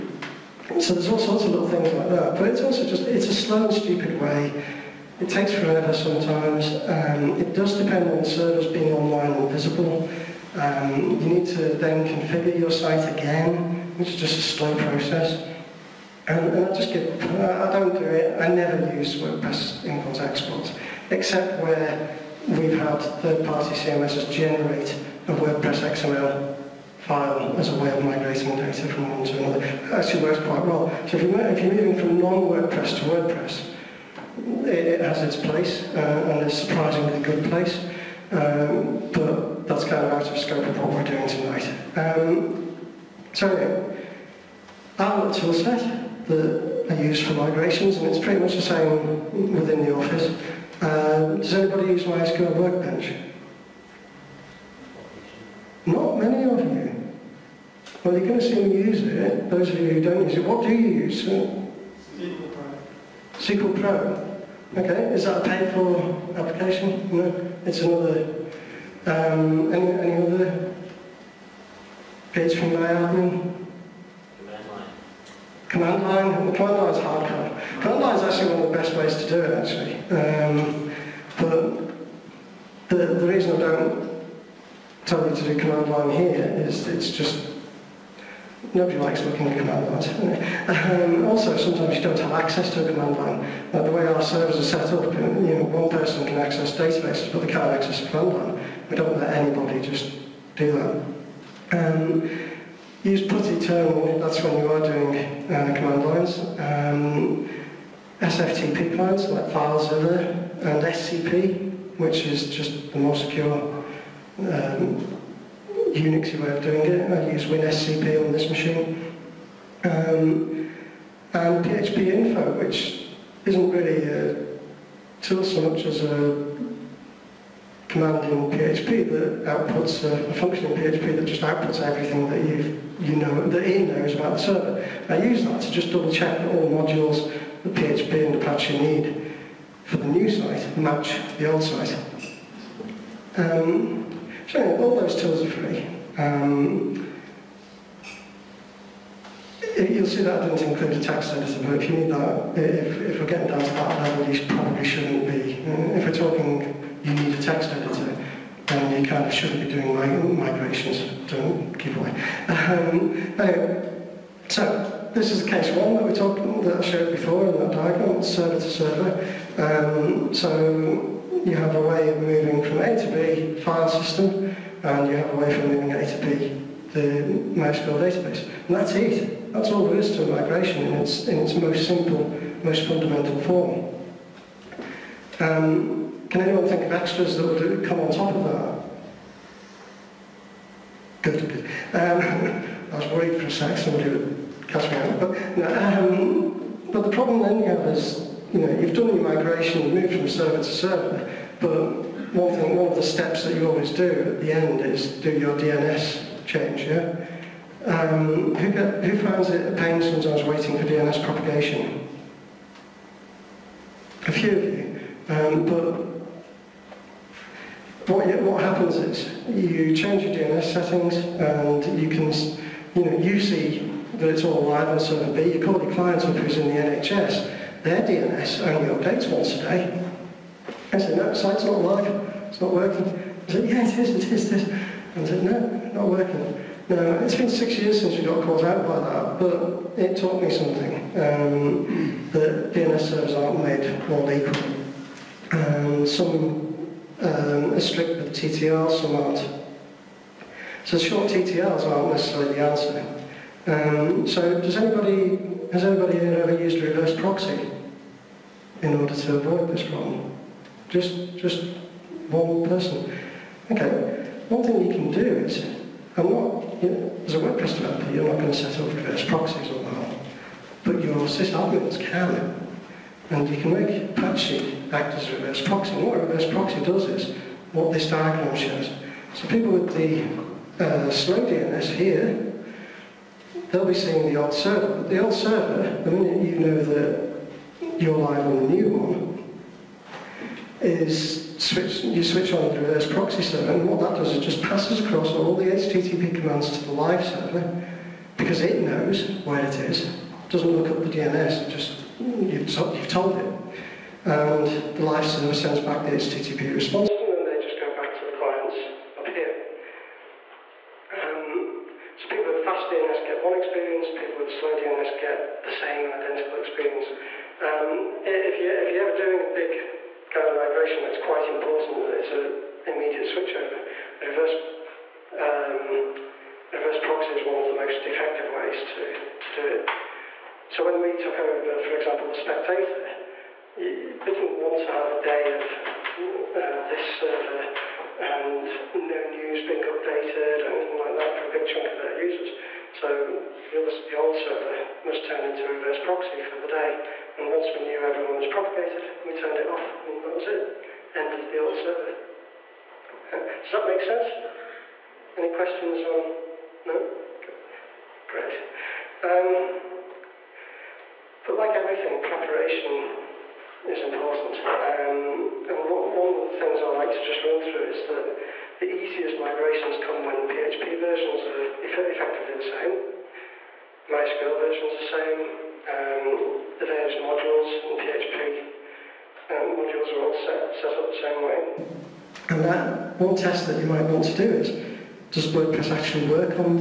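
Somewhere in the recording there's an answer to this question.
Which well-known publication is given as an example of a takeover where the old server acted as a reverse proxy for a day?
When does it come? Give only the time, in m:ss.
5:32.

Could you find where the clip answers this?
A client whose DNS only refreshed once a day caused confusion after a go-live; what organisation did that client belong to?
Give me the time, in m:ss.
3:46.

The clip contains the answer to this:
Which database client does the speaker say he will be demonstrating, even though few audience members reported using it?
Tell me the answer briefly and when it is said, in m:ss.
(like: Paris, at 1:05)
MySQL Workbench, at 0:52.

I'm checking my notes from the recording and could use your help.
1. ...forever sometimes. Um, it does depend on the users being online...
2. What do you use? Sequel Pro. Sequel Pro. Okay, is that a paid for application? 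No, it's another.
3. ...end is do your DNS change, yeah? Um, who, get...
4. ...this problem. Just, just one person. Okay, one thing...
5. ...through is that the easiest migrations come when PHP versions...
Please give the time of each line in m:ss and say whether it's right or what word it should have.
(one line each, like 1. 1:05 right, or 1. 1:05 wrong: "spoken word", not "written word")
1. 0:05 wrong: "servers", not "users"
2. 1:00 right
3. 3:24 right
4. 4:19 right
5. 6:07 right.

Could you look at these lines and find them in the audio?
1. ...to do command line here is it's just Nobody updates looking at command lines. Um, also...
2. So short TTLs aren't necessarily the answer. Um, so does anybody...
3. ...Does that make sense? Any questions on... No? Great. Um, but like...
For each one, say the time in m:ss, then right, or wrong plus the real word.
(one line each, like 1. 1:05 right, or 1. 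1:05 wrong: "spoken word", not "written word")
1. 1:25 wrong: "likes", not "updates"
2. 4:10 right
3. 5:53 right.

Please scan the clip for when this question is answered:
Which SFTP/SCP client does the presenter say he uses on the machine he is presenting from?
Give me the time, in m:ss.
1:57.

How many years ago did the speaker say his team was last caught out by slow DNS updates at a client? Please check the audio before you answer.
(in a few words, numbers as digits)
6.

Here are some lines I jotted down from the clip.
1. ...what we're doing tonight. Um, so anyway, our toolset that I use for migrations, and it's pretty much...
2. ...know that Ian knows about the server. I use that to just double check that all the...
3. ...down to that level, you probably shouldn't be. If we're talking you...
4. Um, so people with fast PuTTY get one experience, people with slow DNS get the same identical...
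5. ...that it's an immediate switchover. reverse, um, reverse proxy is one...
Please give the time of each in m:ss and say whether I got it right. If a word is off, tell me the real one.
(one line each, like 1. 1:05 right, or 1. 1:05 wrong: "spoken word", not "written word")
1. 0:40 right
2. 2:13 right
3. 2:33 right
4. 5:11 wrong: "DNS", not "PuTTY"
5. 5:22 right.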